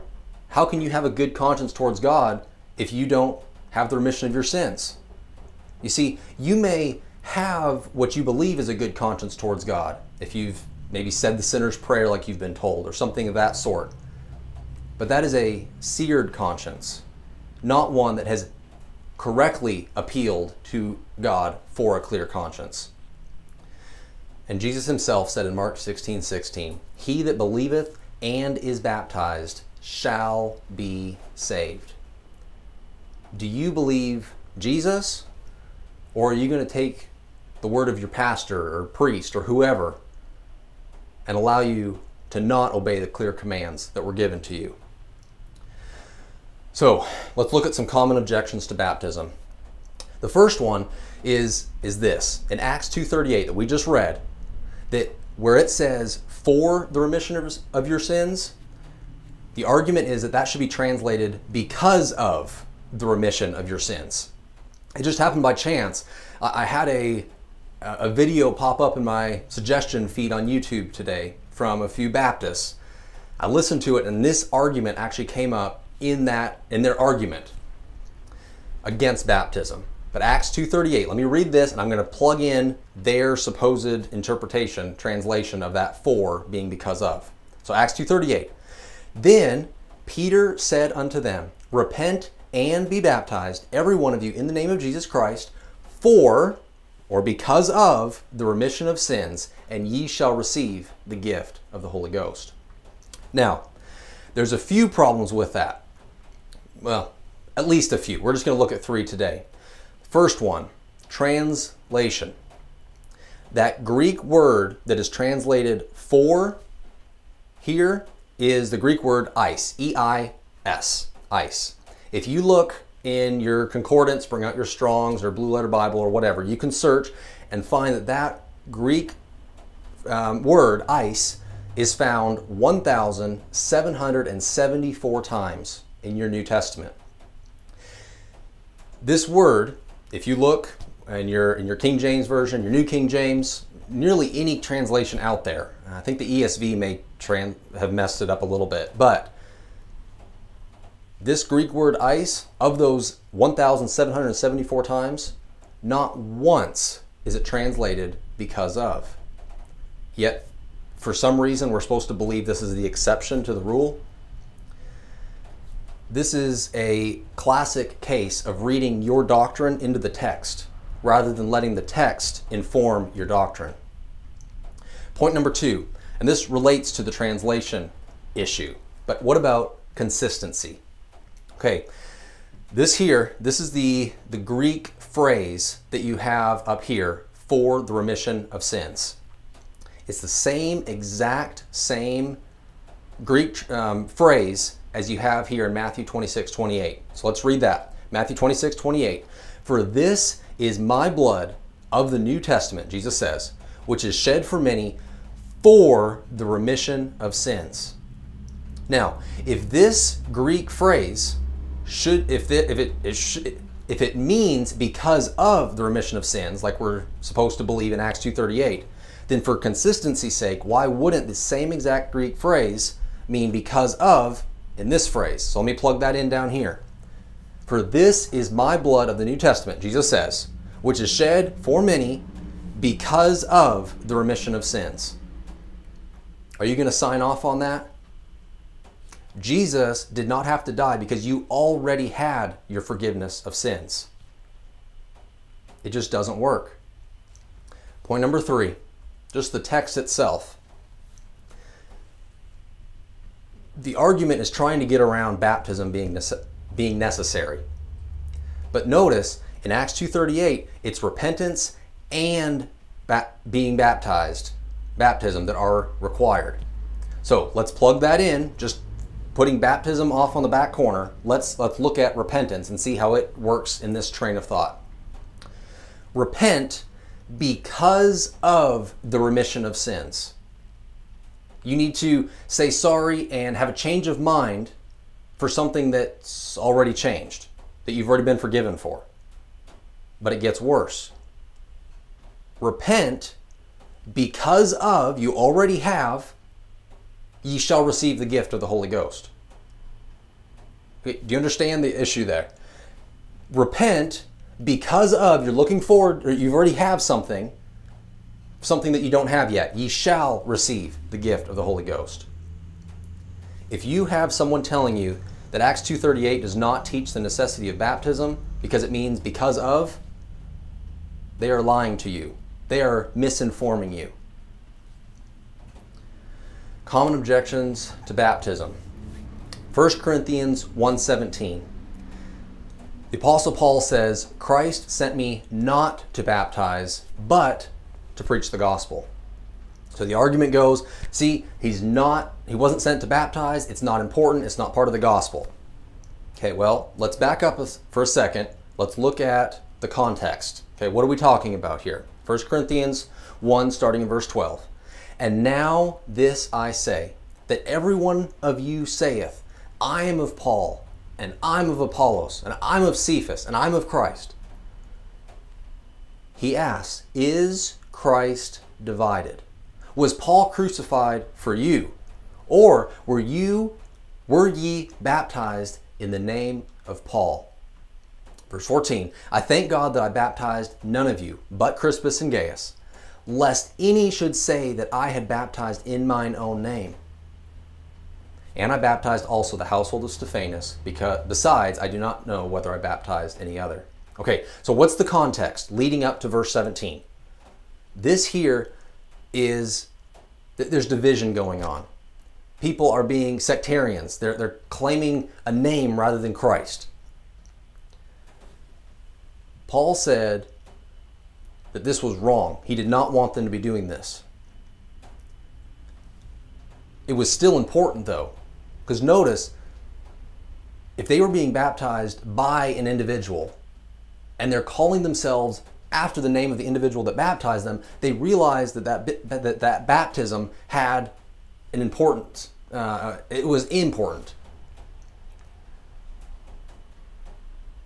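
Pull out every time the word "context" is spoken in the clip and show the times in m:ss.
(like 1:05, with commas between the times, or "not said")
5:49, 6:35.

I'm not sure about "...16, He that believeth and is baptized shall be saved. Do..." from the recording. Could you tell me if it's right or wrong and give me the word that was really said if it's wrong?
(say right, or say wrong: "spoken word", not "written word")
right.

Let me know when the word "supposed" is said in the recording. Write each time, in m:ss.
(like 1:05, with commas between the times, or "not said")
1:23, 2:41, 3:37.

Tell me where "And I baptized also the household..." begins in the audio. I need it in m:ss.
6:28.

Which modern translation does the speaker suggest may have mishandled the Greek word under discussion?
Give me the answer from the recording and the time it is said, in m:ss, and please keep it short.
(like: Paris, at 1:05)
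ESV, at 2:26.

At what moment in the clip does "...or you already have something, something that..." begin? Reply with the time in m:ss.
5:06.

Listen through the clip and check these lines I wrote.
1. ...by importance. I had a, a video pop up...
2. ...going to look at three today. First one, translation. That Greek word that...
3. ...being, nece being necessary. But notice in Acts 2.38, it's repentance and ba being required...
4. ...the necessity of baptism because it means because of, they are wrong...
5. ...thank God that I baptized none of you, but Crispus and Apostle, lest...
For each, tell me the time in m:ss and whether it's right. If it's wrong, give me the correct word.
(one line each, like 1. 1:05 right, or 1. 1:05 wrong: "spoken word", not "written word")
1. 1:05 wrong: "chance", not "importance"
2. 1:48 right
3. 4:15 wrong: "baptized", not "required"
4. 5:17 wrong: "lying", not "wrong"
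5. 6:19 wrong: "Gaius", not "Apostle".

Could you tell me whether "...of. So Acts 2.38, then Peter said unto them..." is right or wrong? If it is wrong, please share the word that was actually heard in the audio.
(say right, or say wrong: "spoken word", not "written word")
right.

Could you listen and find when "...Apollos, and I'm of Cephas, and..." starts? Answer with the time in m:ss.
6:01.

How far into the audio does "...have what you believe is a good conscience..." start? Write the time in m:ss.
0:07.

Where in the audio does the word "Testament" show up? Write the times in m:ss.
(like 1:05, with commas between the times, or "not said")
2:16, 3:22, 3:49.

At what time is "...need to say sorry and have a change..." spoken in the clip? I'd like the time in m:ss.
4:41.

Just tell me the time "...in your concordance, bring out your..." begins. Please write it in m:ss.
2:03.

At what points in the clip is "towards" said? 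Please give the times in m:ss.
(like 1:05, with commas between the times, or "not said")
0:01, 0:09.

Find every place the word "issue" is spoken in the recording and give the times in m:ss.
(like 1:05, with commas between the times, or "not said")
2:58, 5:01.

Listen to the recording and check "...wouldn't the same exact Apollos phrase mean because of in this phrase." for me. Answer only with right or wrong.
wrong.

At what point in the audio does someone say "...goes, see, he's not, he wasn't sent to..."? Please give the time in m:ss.
5:40.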